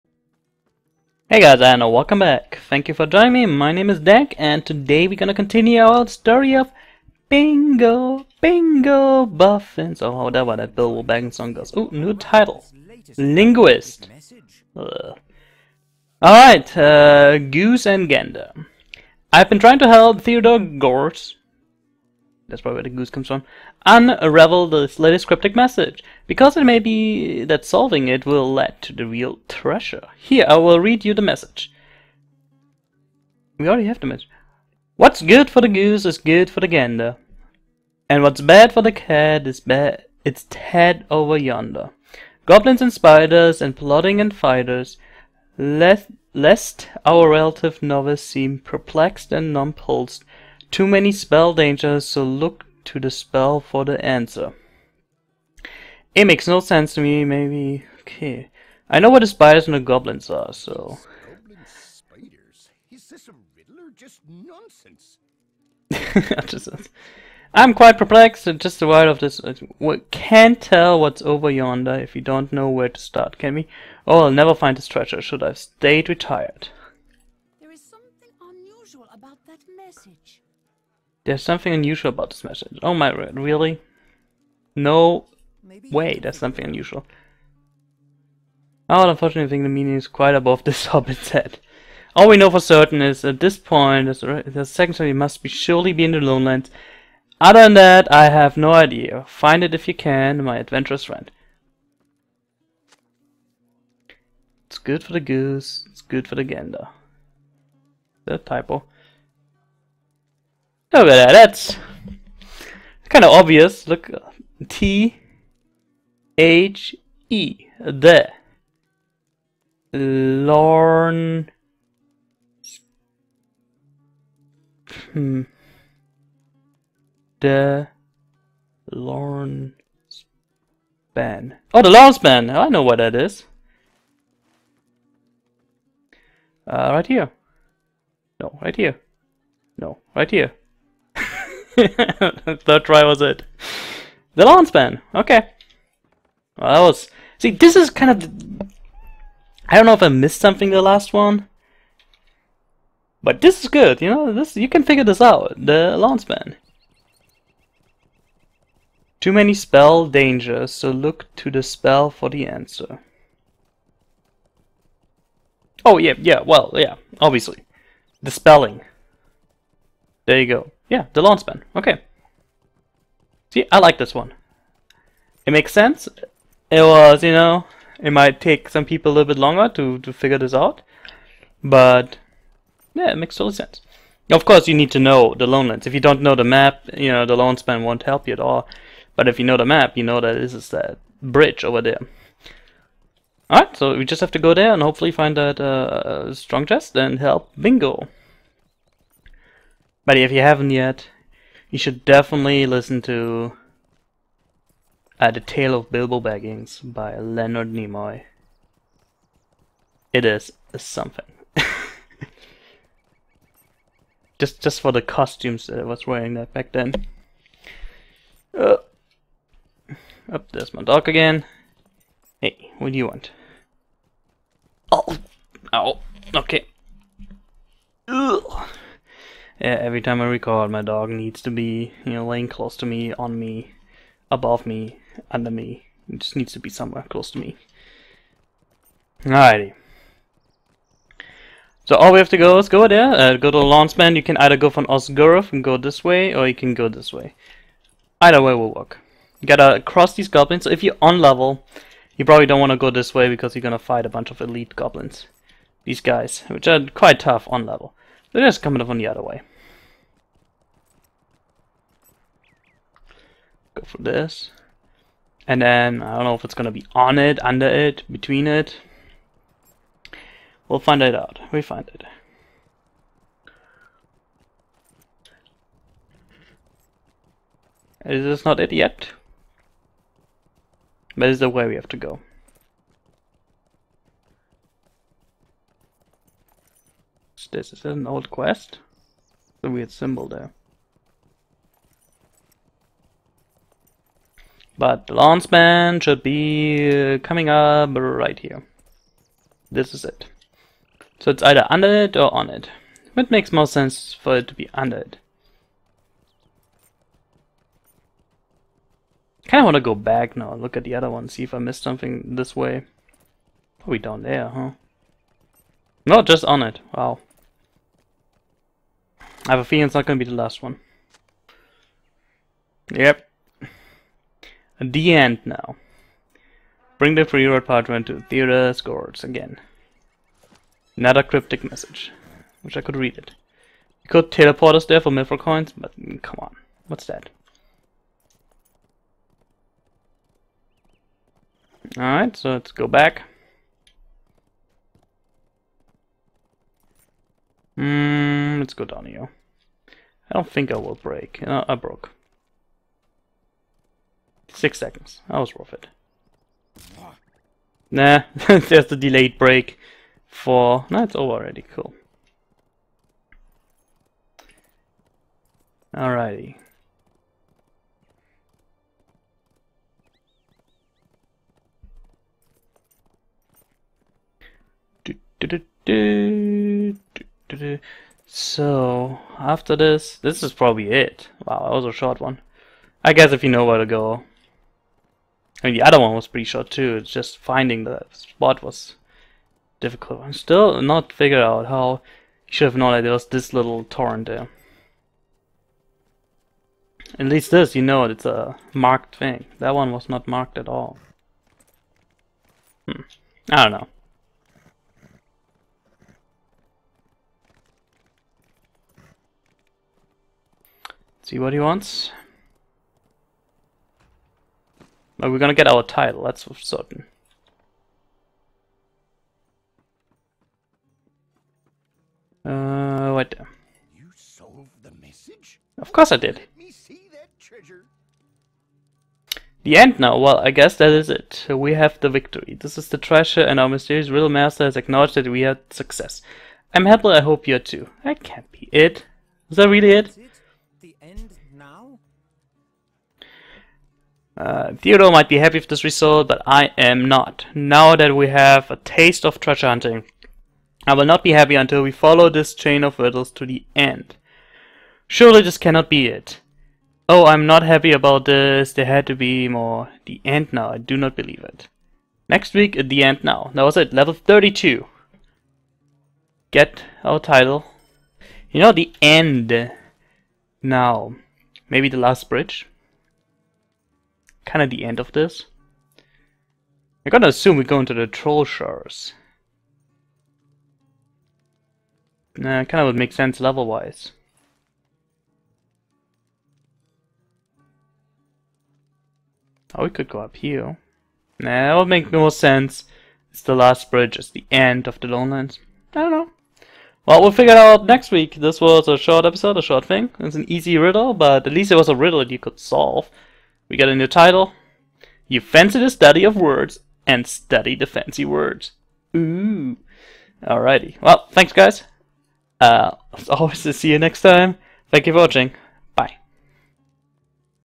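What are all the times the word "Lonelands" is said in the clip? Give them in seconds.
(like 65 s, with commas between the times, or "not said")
185 s, 495 s.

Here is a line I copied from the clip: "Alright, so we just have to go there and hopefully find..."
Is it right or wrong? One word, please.
right.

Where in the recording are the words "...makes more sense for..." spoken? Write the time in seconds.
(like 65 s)
303 s.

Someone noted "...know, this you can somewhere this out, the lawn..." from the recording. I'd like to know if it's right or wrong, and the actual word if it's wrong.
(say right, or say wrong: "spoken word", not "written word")
wrong: "figure", not "somewhere".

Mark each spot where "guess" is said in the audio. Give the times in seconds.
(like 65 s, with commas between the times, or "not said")
383 s, 430 s.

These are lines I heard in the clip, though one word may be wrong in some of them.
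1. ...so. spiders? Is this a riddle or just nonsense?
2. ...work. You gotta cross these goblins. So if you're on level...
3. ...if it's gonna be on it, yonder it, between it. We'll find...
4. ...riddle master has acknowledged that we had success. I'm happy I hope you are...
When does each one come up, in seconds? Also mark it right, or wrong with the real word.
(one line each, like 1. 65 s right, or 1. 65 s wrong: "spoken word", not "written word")
1. 60 s right
2. 248 s right
3. 266 s wrong: "under", not "yonder"
4. 434 s right.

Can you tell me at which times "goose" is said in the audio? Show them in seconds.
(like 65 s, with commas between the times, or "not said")
17 s, 22 s, 35 s, 105 s.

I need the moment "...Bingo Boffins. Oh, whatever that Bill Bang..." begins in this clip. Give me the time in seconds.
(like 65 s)
8 s.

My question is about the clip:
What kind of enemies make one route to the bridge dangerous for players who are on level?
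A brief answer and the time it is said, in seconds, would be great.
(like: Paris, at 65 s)
Elite goblins, at 254 s.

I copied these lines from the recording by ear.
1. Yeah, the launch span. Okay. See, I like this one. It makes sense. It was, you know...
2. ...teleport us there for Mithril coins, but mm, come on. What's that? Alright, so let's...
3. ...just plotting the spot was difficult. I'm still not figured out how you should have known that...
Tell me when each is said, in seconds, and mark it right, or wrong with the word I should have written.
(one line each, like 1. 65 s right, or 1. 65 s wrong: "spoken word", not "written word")
1. 170 s right
2. 334 s right
3. 387 s wrong: "finding", not "plotting".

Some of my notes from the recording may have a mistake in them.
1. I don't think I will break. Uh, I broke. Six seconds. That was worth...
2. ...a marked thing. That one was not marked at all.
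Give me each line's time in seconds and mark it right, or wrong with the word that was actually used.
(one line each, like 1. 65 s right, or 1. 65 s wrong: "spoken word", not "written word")
1. 350 s right
2. 398 s right.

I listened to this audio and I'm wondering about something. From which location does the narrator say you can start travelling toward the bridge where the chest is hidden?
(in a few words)
Ost Guruth.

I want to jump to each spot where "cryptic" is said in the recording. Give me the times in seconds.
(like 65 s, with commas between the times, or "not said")
25 s, 331 s.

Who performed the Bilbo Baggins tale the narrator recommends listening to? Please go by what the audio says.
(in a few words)
Leonard Nimoy.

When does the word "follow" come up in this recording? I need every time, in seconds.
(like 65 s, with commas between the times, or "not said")
451 s.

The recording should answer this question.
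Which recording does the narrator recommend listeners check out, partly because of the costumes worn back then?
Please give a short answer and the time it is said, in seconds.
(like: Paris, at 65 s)
The Tale of Bilbo Baggins, at 205 s.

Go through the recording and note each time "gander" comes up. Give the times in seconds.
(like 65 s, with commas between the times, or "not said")
18 s, 36 s, 106 s.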